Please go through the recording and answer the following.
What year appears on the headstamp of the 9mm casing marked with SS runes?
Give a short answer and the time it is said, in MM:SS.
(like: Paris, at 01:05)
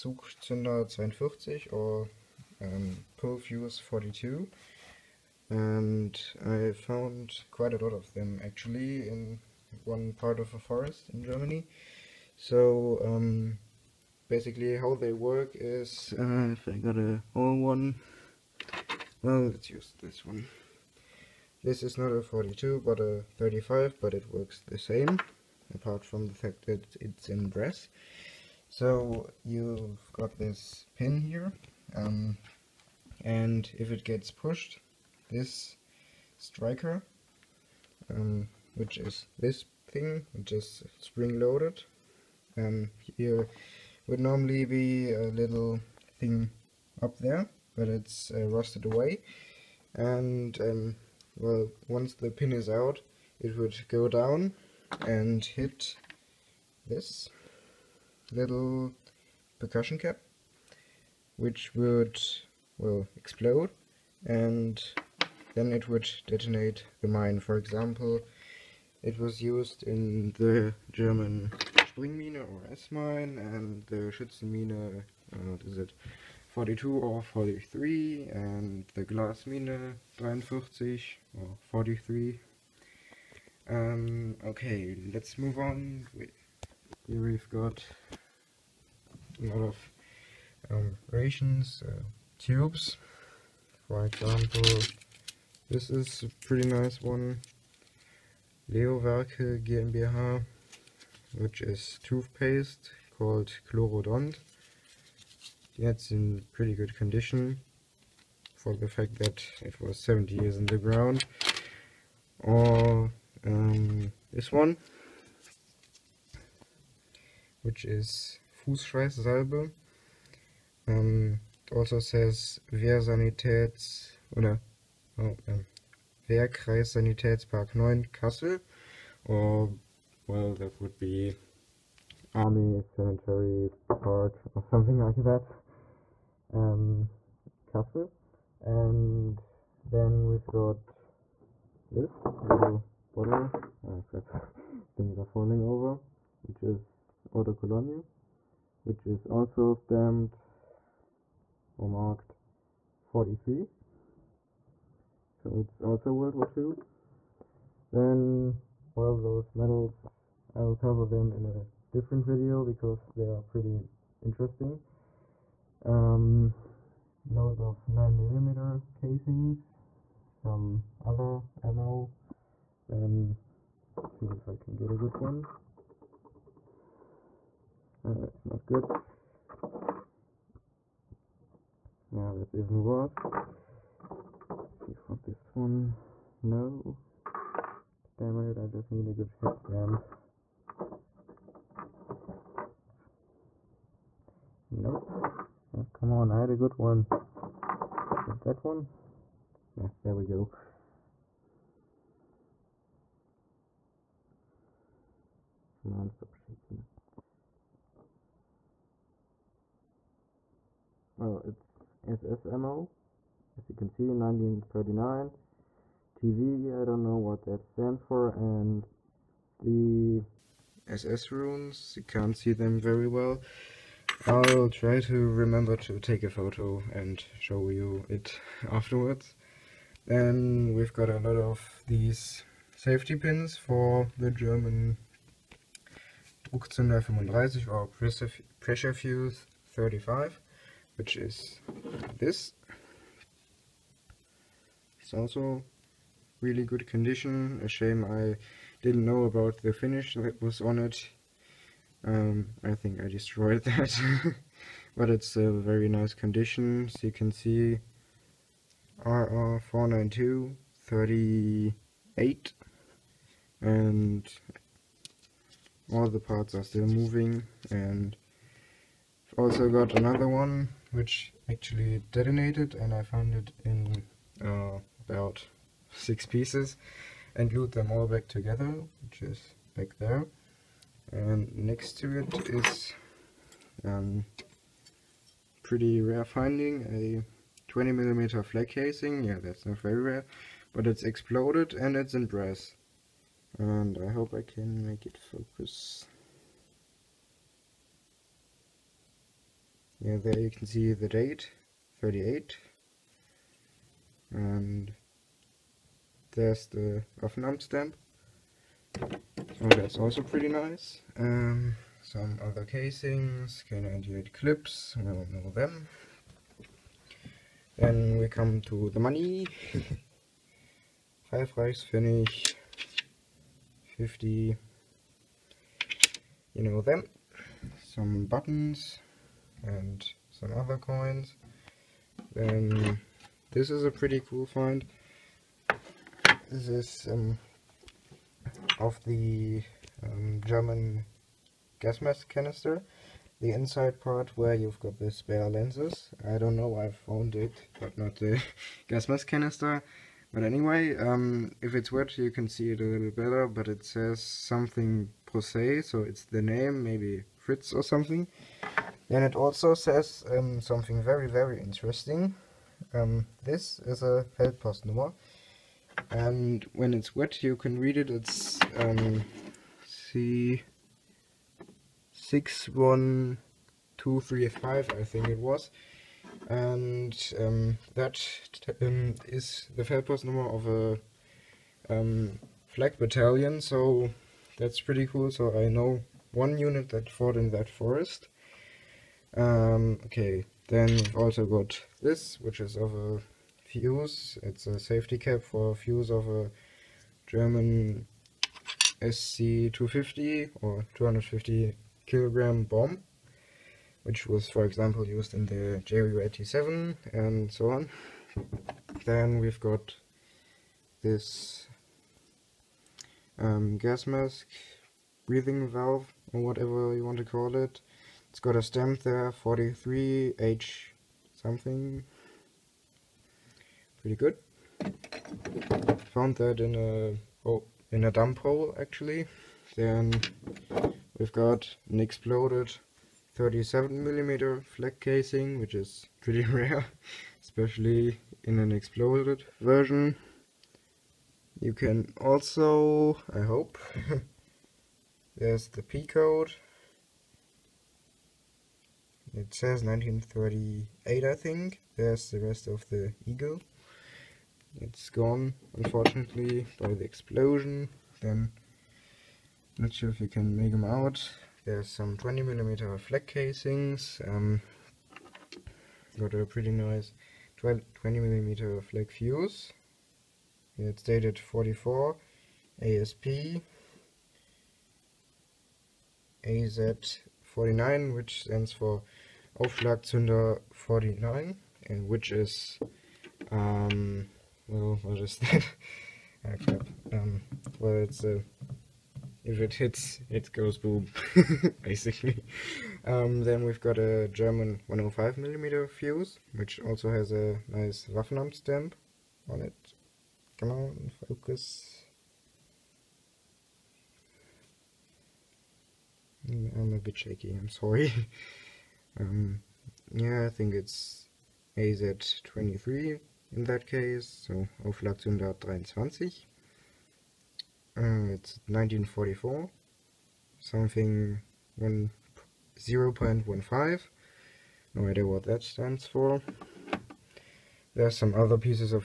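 1939, at 03:34.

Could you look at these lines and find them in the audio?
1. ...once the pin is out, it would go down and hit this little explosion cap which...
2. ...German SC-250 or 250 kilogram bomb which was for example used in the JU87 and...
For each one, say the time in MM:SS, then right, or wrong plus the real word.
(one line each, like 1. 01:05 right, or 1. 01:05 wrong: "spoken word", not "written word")
1. 00:51 wrong: "percussion", not "explosion"
2. 06:37 right.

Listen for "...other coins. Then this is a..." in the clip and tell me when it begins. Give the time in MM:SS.
05:30.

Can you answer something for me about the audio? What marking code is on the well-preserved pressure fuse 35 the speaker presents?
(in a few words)
RR492 38.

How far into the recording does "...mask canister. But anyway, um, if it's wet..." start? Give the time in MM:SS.
05:49.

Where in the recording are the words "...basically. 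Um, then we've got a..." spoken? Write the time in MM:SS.
08:11.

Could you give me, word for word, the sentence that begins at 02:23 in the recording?
Oh crap, things are falling over, which is Auto Colonio, which is also stamped or marked 43.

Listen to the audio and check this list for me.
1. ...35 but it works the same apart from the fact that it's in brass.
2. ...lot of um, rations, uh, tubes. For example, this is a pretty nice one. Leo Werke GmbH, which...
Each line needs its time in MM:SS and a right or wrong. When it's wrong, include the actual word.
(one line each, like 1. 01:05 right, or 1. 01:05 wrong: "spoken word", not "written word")
1. 00:23 right
2. 01:29 right.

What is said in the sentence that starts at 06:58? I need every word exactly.
It's got a stamp there, 43H something.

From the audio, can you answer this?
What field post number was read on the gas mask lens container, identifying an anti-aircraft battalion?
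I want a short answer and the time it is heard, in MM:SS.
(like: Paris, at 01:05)
C61235, at 06:10.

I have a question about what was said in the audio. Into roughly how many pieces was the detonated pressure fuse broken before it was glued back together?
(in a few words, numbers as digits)
6.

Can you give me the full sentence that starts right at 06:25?
So I know one unit that fought in that forest.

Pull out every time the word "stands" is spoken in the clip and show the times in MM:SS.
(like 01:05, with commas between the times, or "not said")
03:37, 07:58, 08:45.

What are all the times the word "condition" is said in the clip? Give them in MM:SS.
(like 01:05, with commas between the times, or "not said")
01:46, 04:06, 04:16.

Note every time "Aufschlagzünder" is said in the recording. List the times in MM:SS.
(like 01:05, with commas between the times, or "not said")
07:59, 08:34.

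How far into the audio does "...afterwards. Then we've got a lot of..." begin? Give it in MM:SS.
03:48.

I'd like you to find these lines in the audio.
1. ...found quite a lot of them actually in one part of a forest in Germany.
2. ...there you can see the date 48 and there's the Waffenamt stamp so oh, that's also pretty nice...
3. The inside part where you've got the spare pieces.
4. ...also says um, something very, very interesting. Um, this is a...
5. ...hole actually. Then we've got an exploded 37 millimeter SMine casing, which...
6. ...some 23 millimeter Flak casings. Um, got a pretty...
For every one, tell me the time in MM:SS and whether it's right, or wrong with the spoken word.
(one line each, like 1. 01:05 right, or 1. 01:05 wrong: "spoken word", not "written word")
1. 00:06 right
2. 05:00 wrong: "38", not "48"
3. 05:43 wrong: "lenses", not "pieces"
4. 05:59 right
5. 07:08 wrong: "Flak", not "SMine"
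6. 07:41 wrong: "20", not "23".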